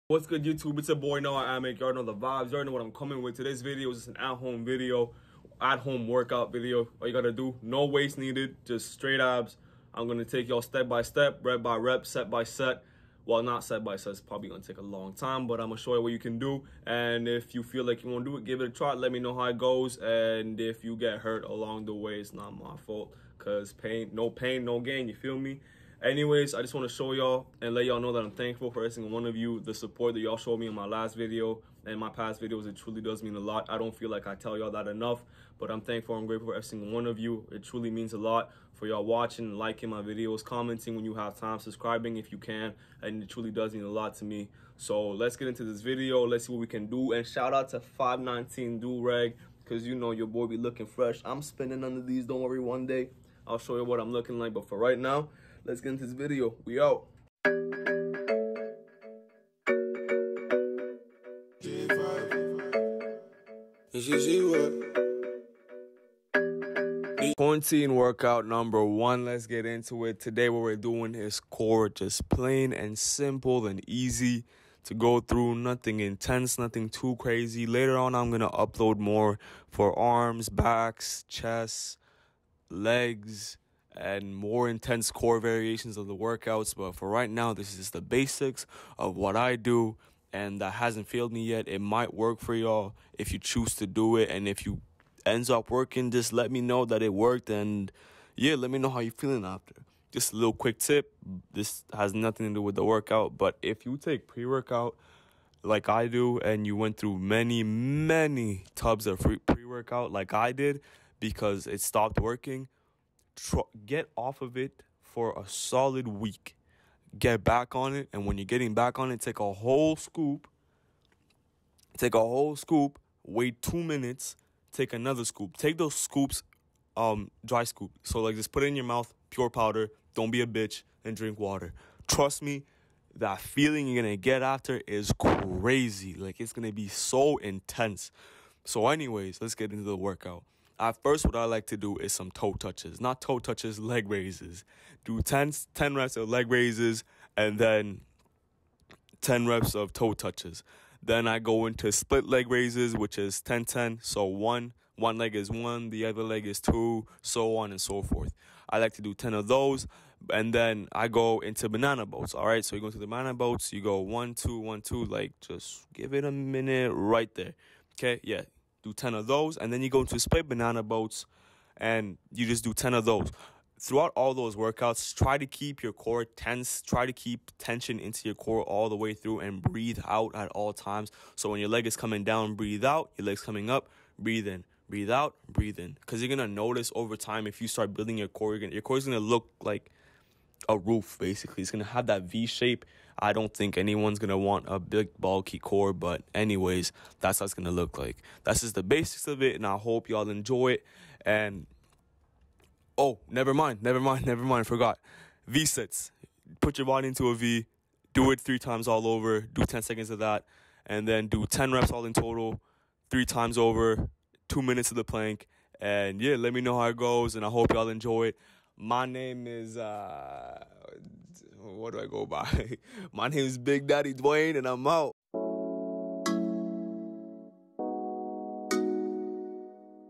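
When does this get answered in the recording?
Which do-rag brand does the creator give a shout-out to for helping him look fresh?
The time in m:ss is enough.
0:47.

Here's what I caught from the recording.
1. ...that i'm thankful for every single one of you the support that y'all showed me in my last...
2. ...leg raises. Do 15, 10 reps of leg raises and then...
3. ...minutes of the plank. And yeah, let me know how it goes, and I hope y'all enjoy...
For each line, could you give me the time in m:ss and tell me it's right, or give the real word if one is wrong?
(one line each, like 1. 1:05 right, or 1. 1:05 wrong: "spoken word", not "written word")
1. 0:28 right
2. 2:23 wrong: "10", not "15"
3. 3:34 right.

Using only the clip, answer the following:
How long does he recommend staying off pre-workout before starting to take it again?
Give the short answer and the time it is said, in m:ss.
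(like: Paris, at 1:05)
a solid week, at 1:55.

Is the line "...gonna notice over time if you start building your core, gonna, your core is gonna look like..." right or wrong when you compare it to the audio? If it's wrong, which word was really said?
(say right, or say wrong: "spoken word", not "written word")
right.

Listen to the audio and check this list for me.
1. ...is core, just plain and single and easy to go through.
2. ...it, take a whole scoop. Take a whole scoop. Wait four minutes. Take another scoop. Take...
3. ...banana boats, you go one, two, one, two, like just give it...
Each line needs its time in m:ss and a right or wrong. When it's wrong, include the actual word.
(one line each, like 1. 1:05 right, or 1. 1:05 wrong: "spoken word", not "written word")
1. 1:11 wrong: "simple", not "single"
2. 1:59 wrong: "two", not "four"
3. 2:43 right.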